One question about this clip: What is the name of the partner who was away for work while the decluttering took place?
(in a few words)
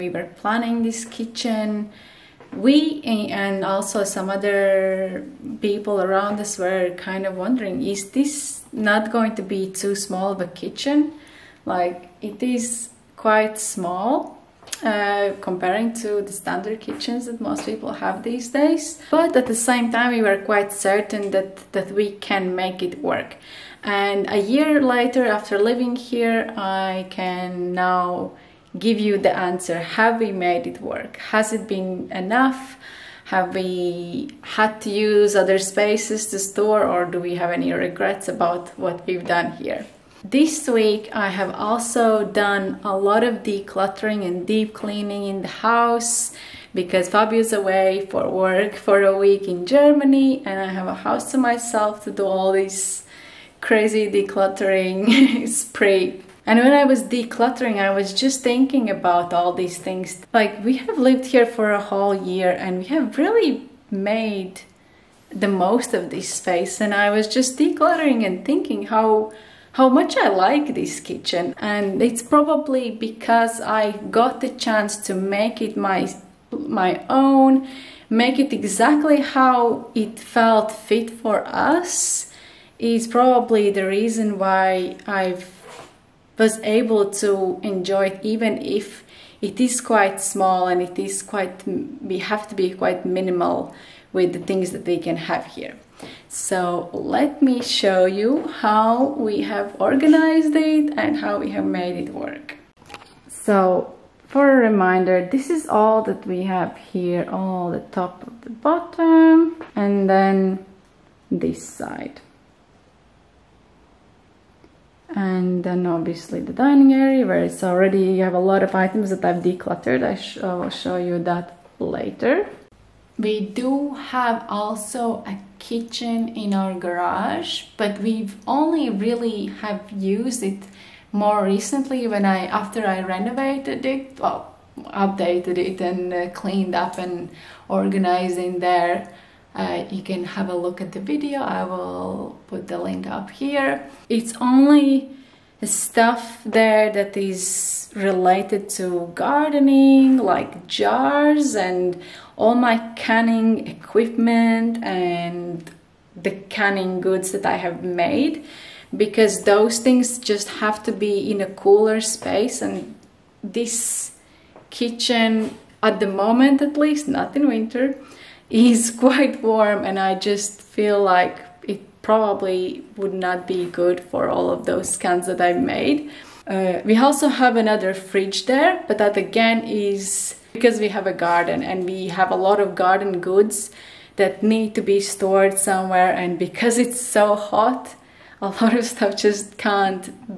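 Fabio.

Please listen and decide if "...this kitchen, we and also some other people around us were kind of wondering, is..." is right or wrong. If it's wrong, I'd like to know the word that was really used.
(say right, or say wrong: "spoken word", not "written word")
right.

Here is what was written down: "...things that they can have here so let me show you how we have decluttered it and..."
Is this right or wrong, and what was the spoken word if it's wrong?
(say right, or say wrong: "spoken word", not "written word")
wrong: "organized", not "decluttered".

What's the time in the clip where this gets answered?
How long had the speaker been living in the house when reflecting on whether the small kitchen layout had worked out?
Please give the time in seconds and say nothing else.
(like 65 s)
24 s.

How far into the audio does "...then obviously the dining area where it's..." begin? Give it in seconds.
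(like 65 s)
115 s.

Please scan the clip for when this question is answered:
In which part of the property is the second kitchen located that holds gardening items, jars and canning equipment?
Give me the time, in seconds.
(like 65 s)
126 s.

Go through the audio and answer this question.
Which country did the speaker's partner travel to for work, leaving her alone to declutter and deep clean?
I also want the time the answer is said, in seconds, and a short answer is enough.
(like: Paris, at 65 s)
Germany, at 49 s.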